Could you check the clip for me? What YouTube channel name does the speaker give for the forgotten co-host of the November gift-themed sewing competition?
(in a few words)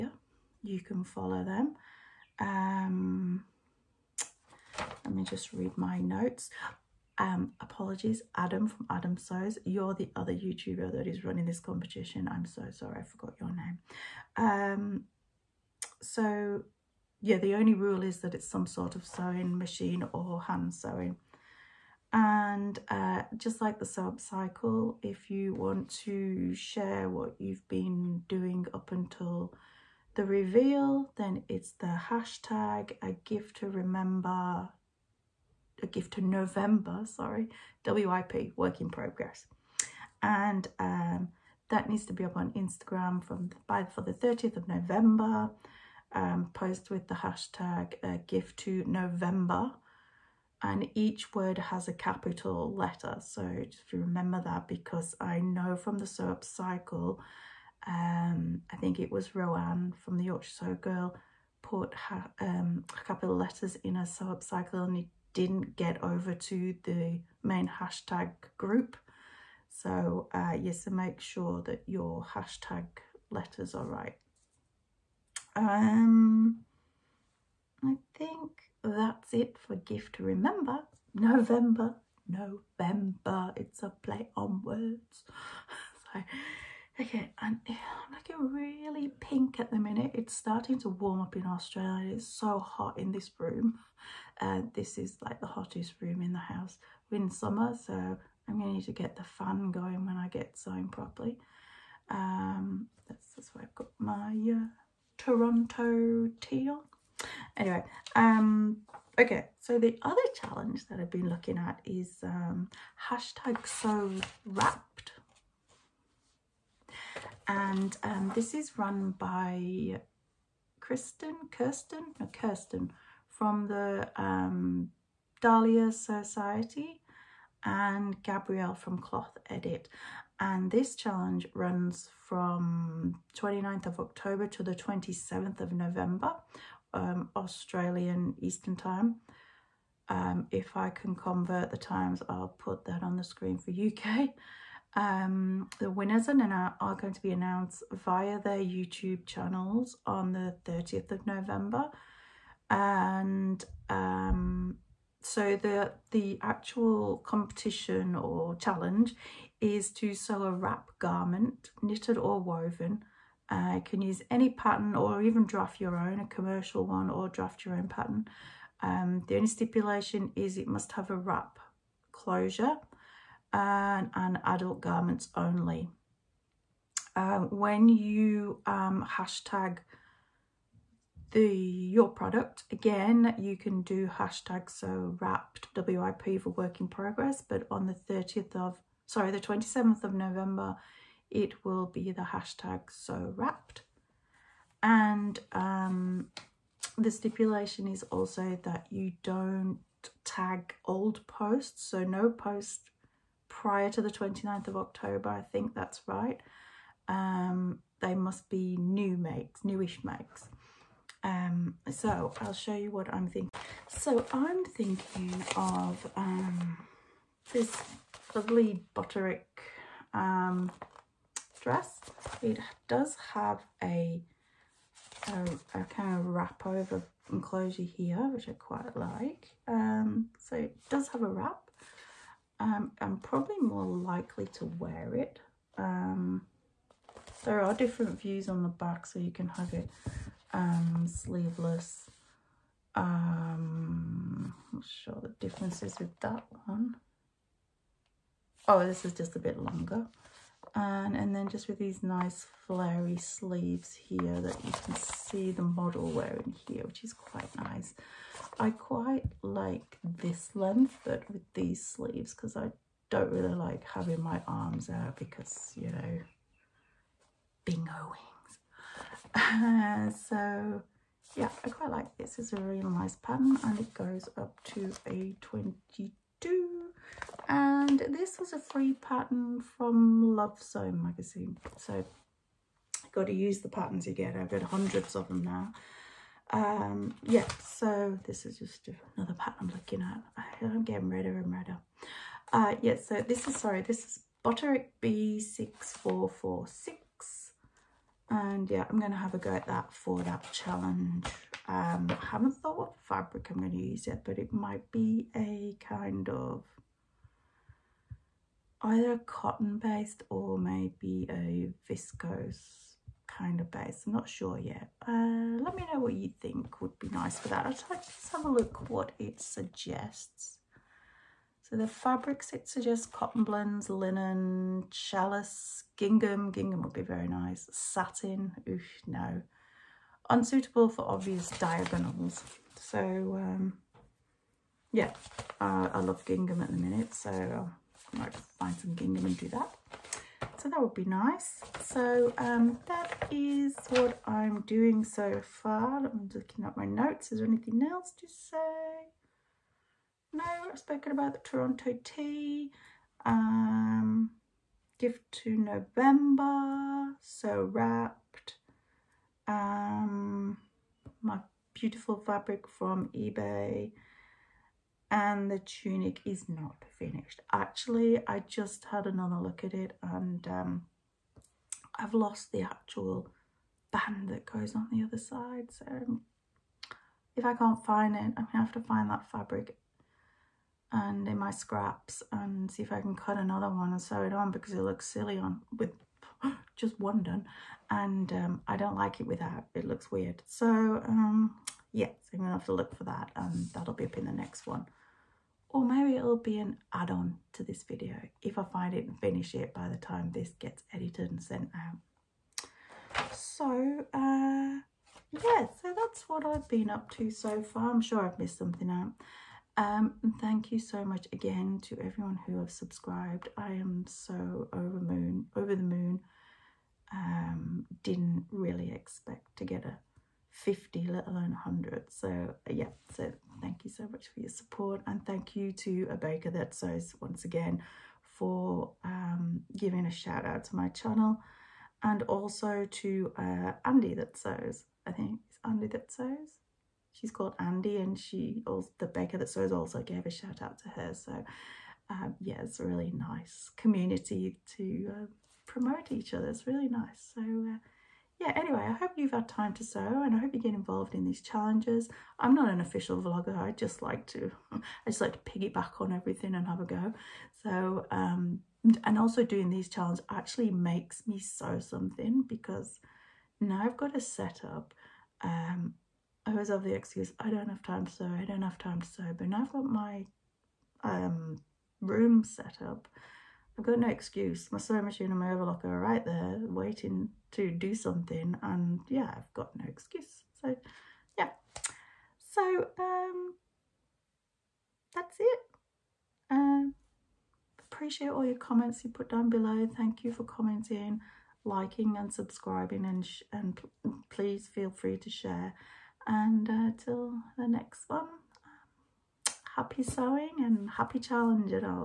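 Adam Sews.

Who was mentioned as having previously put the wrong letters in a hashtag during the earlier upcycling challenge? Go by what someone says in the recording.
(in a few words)
Roanne.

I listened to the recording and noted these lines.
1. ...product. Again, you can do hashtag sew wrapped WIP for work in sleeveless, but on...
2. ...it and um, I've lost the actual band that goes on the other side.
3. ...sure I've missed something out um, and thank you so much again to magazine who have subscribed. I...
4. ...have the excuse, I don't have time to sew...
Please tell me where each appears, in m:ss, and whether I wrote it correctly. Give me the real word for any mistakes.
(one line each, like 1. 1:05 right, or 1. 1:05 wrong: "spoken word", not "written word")
1. 3:02 wrong: "progress", not "sleeveless"
2. 6:09 right
3. 6:48 wrong: "everyone", not "magazine"
4. 7:46 right.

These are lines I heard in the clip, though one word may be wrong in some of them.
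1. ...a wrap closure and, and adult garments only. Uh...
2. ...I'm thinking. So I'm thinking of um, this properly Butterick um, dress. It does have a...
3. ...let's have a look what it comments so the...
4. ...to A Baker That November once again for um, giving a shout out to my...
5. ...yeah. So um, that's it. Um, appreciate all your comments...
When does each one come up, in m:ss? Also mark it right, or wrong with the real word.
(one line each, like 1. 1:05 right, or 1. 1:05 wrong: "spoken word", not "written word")
1. 2:51 right
2. 3:33 wrong: "lovely", not "properly"
3. 5:17 wrong: "suggests", not "comments"
4. 7:05 wrong: "Sews", not "November"
5. 8:01 right.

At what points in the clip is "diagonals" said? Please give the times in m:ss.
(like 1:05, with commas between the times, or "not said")
5:31.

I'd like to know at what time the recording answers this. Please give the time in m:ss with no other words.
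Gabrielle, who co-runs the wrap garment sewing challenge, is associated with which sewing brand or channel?
2:08.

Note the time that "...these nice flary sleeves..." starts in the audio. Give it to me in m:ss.
4:11.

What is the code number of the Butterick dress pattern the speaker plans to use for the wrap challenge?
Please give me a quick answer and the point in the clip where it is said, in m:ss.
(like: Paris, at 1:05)
B6446, at 4:55.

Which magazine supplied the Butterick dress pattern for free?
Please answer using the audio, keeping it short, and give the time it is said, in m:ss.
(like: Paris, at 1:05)
Love Sewing, at 4:40.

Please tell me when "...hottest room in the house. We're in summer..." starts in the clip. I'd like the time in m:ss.
1:35.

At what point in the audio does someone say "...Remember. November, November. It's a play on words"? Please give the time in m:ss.
1:20.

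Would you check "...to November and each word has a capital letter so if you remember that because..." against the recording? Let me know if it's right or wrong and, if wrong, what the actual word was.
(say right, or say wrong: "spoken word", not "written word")
right.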